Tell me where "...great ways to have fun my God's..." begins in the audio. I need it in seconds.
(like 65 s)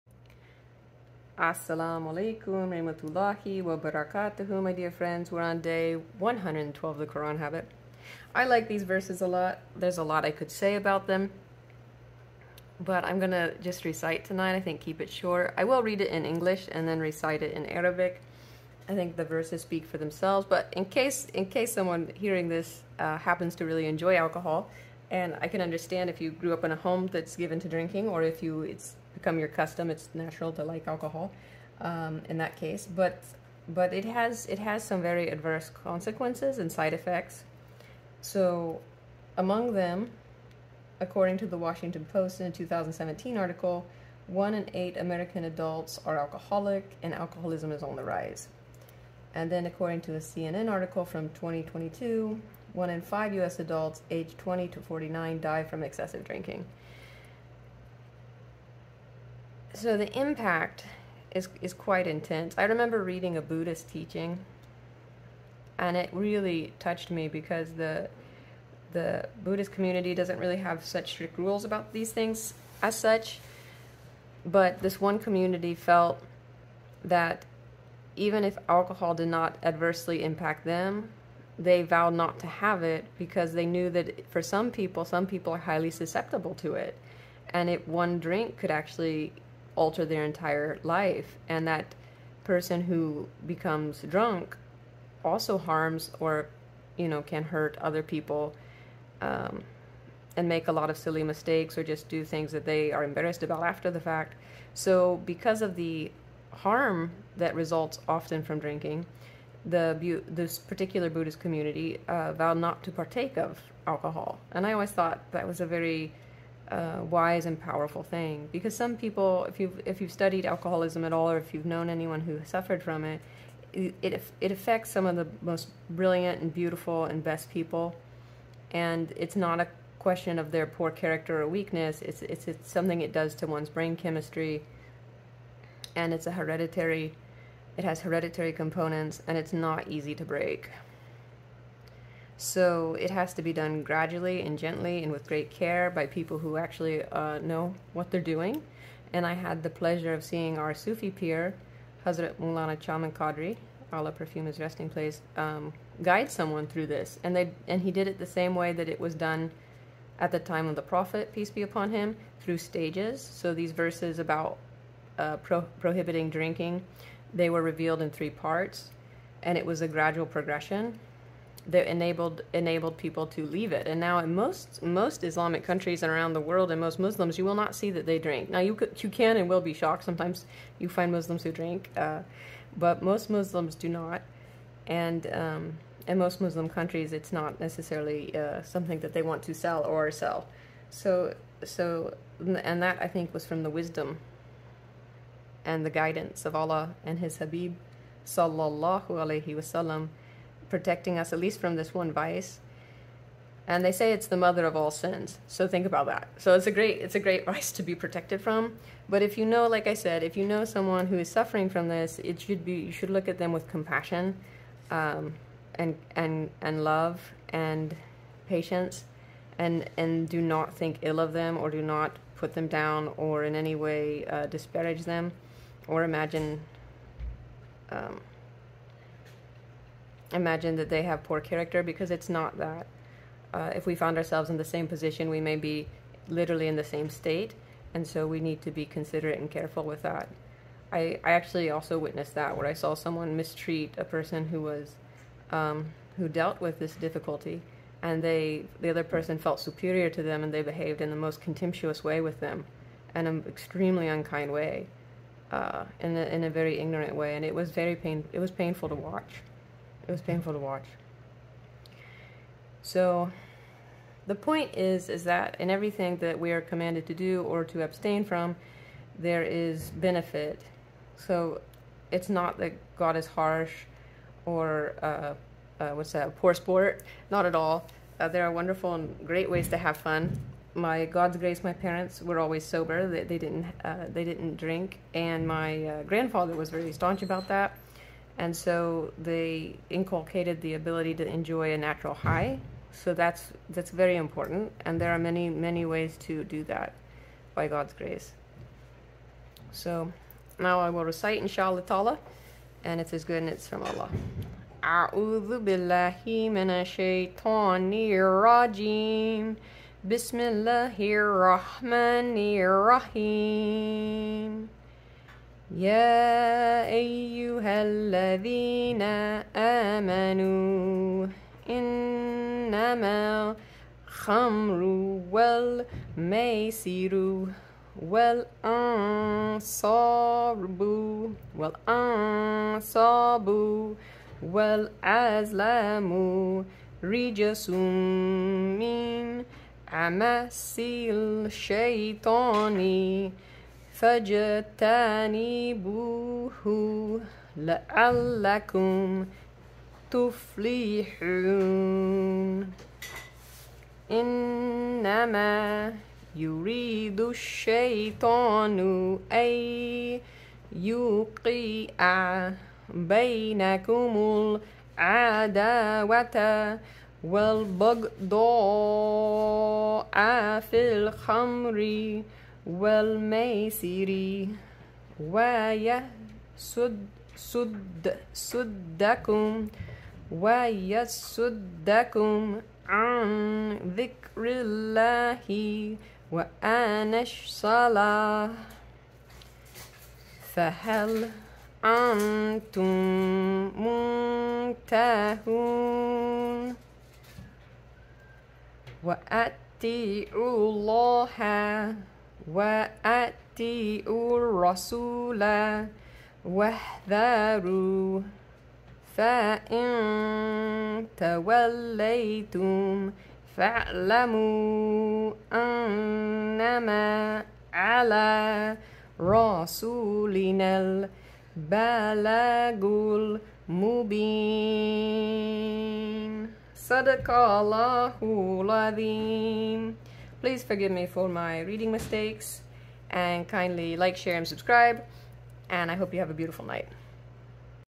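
279 s.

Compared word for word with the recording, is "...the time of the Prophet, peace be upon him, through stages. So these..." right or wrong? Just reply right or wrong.
right.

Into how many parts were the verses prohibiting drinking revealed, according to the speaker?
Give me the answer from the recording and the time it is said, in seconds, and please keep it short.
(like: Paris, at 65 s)
3, at 168 s.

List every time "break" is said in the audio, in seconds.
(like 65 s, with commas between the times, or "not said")
140 s.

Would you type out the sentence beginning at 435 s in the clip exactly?
And I hope you have a beautiful night.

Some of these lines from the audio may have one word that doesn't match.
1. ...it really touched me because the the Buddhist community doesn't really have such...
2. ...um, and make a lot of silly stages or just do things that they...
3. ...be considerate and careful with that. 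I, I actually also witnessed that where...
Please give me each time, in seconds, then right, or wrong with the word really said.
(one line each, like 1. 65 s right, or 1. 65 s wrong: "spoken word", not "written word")
1. 65 s right
2. 99 s wrong: "mistakes", not "stages"
3. 238 s right.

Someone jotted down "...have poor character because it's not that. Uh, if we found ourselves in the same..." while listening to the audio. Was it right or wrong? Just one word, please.
right.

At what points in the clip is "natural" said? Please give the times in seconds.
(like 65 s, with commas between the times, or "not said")
30 s, 291 s.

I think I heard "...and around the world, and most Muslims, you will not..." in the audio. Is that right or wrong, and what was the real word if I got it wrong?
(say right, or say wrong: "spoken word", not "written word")
right.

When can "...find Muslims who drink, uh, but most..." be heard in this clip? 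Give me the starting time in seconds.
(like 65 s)
180 s.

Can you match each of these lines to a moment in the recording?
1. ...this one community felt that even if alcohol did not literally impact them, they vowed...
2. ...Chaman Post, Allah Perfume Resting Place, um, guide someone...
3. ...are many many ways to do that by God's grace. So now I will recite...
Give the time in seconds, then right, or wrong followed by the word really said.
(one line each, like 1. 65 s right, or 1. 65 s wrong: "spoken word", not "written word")
1. 74 s wrong: "adversely", not "literally"
2. 152 s wrong: "Qadri", not "Post"
3. 295 s right.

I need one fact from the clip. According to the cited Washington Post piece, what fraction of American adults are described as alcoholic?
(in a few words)
1 in 8.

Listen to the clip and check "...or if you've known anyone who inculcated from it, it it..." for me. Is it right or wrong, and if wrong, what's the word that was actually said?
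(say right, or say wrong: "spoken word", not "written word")
wrong: "suffered", not "inculcated".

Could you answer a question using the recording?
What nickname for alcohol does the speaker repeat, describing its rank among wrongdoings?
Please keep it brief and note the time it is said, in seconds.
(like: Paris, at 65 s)
mother of all sins, at 204 s.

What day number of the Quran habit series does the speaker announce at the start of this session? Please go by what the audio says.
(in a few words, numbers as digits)
112.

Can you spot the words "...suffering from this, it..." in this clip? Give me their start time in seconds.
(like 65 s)
211 s.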